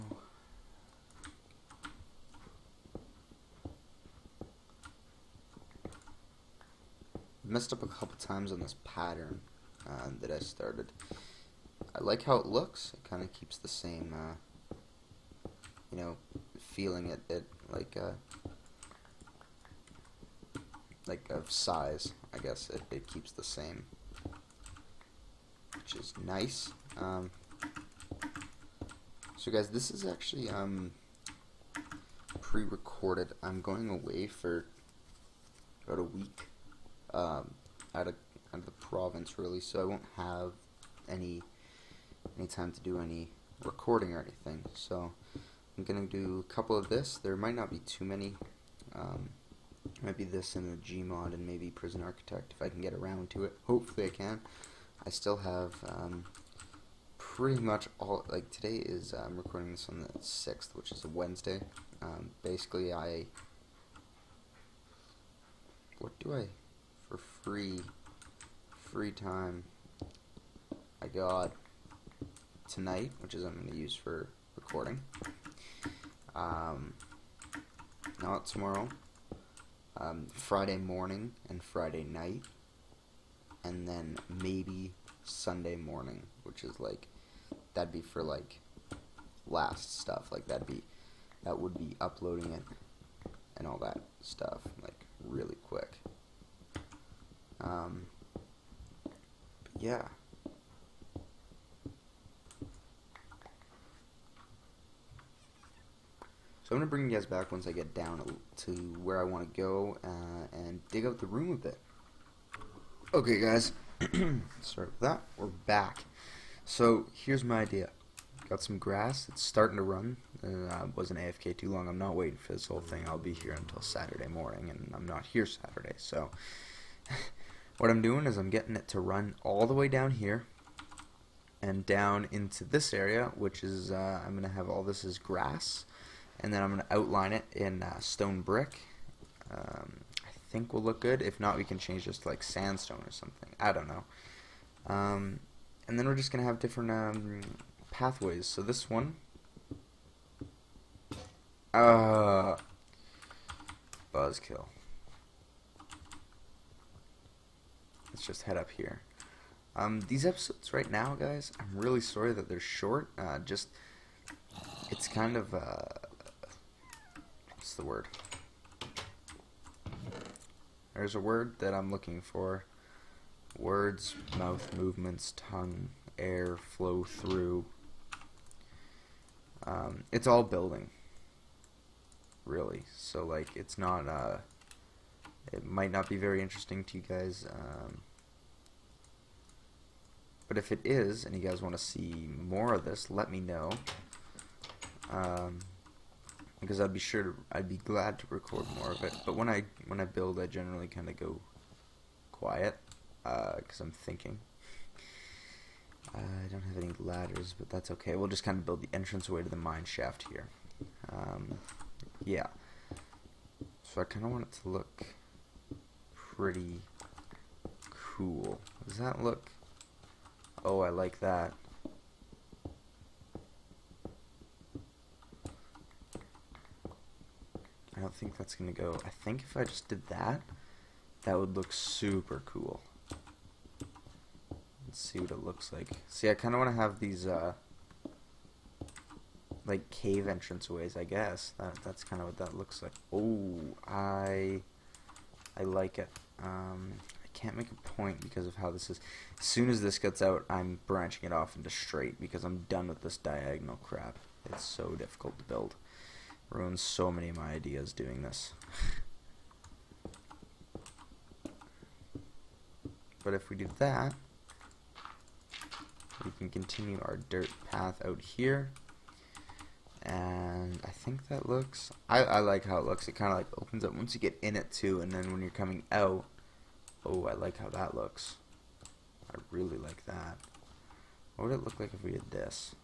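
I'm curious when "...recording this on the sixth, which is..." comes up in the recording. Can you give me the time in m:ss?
0:59.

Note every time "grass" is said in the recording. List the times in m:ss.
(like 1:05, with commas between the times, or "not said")
1:58, 2:15.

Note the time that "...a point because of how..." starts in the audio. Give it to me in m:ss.
4:07.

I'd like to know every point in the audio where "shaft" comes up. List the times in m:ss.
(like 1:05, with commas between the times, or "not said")
3:29.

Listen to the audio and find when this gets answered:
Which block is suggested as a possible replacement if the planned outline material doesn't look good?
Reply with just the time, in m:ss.
2:22.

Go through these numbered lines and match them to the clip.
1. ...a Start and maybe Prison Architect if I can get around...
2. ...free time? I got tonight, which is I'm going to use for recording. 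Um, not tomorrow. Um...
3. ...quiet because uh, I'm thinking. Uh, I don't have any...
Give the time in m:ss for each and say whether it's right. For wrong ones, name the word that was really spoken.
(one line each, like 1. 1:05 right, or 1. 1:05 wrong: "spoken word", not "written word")
1. 0:50 wrong: "Gmod", not "Start"
2. 1:08 right
3. 3:22 right.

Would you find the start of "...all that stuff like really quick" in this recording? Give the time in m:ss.
1:33.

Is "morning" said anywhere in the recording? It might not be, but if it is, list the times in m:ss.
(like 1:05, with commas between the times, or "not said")
1:20, 1:25, 2:04.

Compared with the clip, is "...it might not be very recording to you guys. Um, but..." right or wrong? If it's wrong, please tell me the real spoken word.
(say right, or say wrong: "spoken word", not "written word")
wrong: "interesting", not "recording".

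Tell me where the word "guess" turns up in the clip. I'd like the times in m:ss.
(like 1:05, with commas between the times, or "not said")
0:22, 4:01.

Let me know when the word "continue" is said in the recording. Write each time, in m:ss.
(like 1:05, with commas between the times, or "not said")
4:26.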